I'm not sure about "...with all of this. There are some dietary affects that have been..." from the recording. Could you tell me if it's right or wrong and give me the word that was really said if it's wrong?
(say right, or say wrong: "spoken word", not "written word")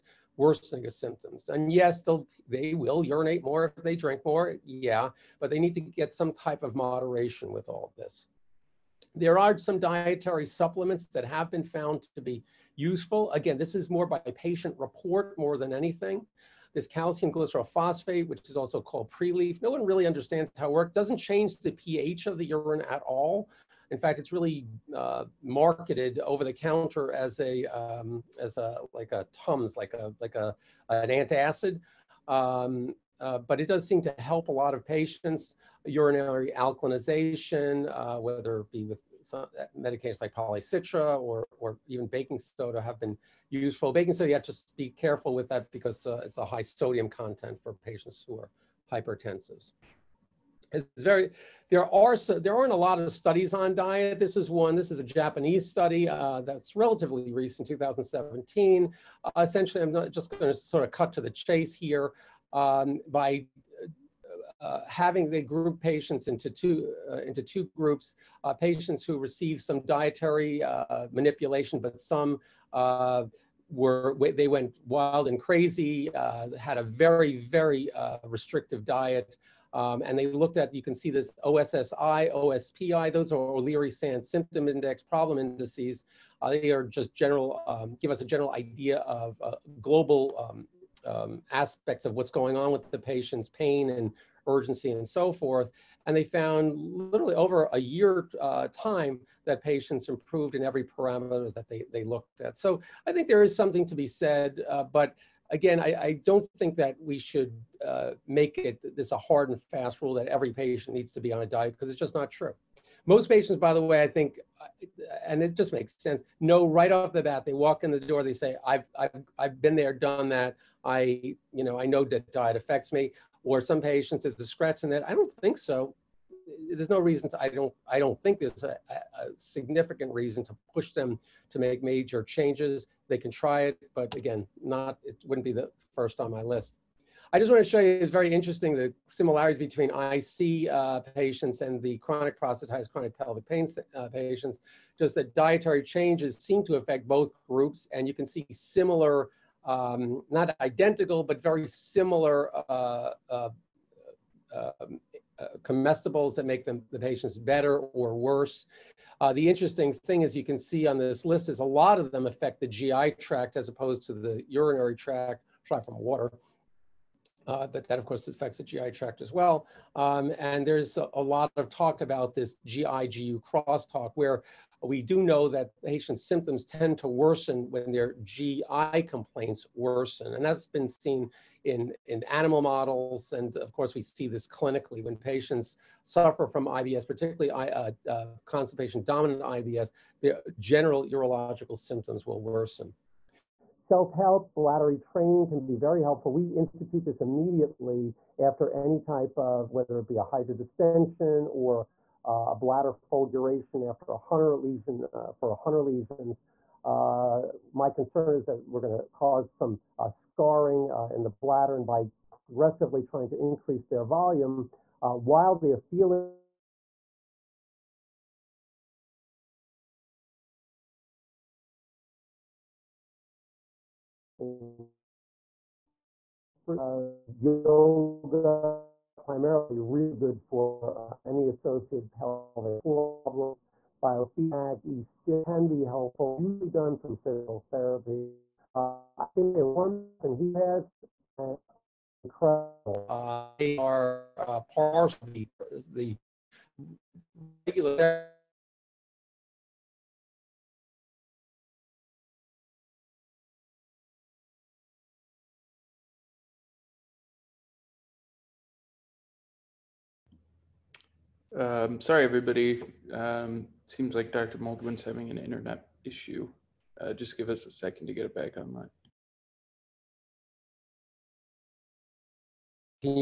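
wrong: "supplements", not "affects".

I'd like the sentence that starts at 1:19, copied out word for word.
Um, and they looked at, you can see this OSSI, OSPI, those are O'Leary-Sant symptom index problem indices.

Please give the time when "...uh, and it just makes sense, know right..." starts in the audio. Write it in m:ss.
1:54.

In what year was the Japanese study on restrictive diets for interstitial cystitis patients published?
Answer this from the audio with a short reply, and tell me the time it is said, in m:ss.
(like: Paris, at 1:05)
2017, at 0:57.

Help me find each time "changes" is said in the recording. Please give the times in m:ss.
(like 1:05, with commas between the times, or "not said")
0:21, 2:12, 2:25.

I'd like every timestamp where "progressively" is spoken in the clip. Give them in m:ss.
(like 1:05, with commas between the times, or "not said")
3:32.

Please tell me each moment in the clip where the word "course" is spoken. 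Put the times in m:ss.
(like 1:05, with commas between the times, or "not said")
2:48, 3:03.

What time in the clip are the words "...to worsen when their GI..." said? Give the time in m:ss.
2:56.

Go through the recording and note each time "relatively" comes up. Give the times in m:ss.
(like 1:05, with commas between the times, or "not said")
0:56.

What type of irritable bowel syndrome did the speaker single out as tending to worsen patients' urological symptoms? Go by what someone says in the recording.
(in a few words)
Constipation dominant.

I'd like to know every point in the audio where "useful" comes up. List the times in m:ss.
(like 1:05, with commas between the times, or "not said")
0:12, 0:43.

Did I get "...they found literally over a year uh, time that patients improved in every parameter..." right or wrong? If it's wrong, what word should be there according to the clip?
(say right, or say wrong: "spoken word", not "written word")
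right.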